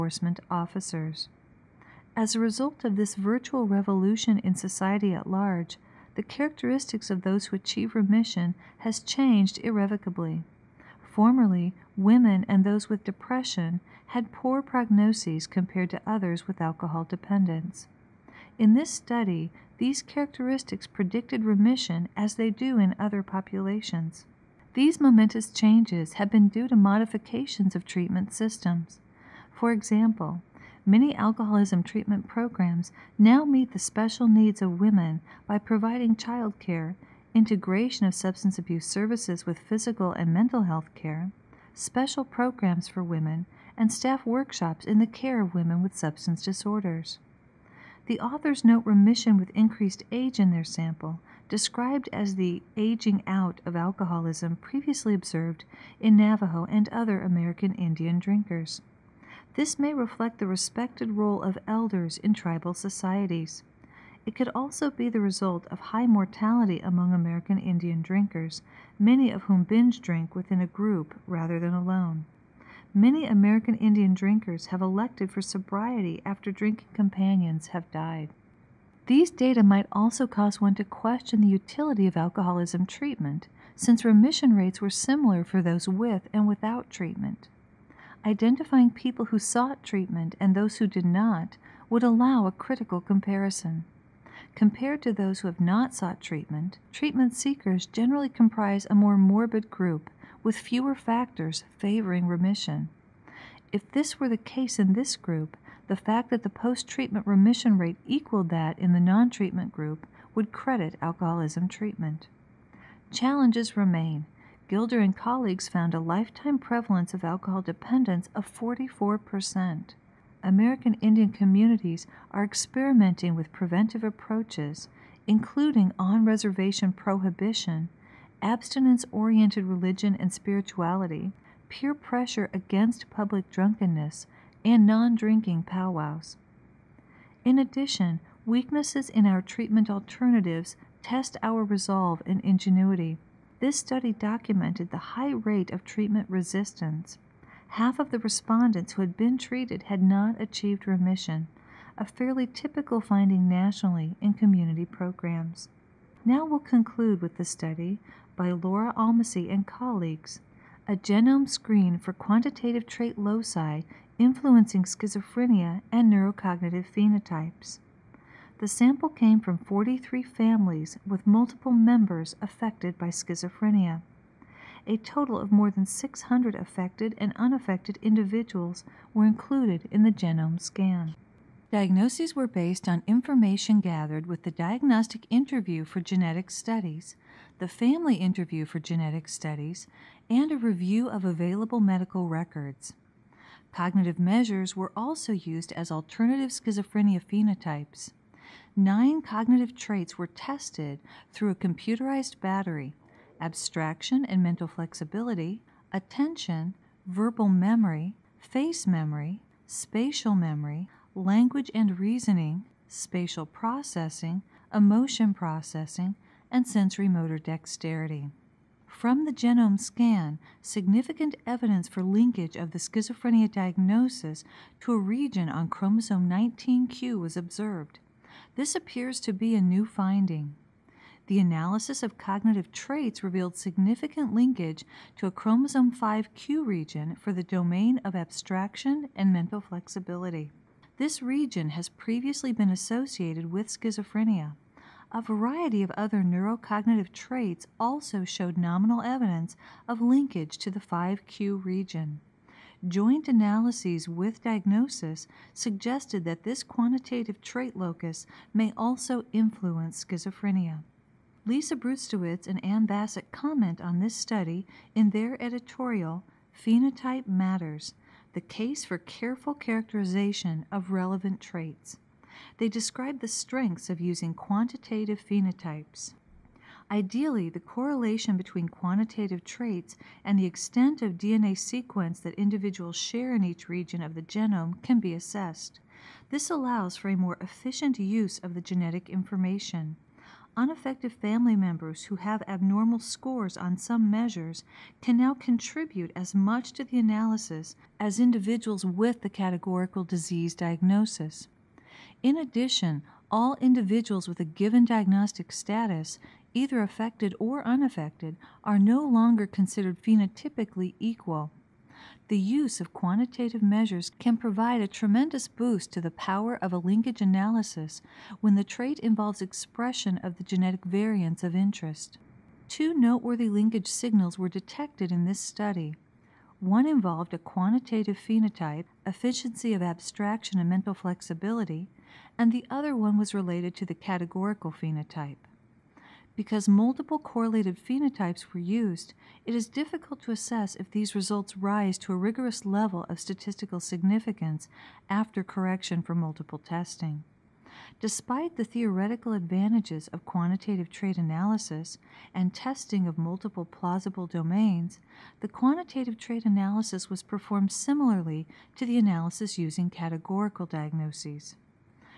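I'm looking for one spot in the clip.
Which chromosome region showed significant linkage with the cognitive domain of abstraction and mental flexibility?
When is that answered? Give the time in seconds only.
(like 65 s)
235 s.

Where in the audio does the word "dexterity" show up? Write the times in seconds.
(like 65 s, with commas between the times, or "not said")
217 s.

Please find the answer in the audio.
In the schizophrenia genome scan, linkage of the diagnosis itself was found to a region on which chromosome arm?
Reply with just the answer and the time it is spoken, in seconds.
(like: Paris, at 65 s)
19q, at 225 s.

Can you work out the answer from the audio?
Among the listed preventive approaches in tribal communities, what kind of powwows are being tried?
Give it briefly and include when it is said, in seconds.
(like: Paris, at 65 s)
Non drinking powwows, at 134 s.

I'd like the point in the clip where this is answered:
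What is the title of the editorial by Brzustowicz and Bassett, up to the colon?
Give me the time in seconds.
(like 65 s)
266 s.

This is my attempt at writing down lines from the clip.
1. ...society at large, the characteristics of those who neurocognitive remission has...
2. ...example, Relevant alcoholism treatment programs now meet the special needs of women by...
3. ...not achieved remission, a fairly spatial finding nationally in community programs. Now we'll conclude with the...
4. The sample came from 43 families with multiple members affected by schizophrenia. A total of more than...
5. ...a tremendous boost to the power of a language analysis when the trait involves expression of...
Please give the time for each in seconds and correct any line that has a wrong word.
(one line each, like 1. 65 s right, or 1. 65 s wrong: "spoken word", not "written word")
1. 4 s wrong: "achieve", not "neurocognitive"
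2. 29 s wrong: "Many", not "Relevant"
3. 150 s wrong: "typical", not "spatial"
4. 168 s right
5. 314 s wrong: "linkage", not "language".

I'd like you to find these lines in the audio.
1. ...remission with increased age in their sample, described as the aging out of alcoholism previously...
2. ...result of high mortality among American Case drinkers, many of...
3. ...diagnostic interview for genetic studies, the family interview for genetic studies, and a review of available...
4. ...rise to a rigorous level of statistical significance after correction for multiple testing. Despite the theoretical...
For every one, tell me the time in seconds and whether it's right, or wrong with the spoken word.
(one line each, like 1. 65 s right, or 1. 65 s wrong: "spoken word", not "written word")
1. 48 s right
2. 65 s wrong: "Indian", not "Case"
3. 184 s right
4. 341 s right.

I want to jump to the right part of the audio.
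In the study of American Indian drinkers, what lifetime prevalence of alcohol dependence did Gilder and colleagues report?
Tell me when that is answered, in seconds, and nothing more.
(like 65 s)
118 s.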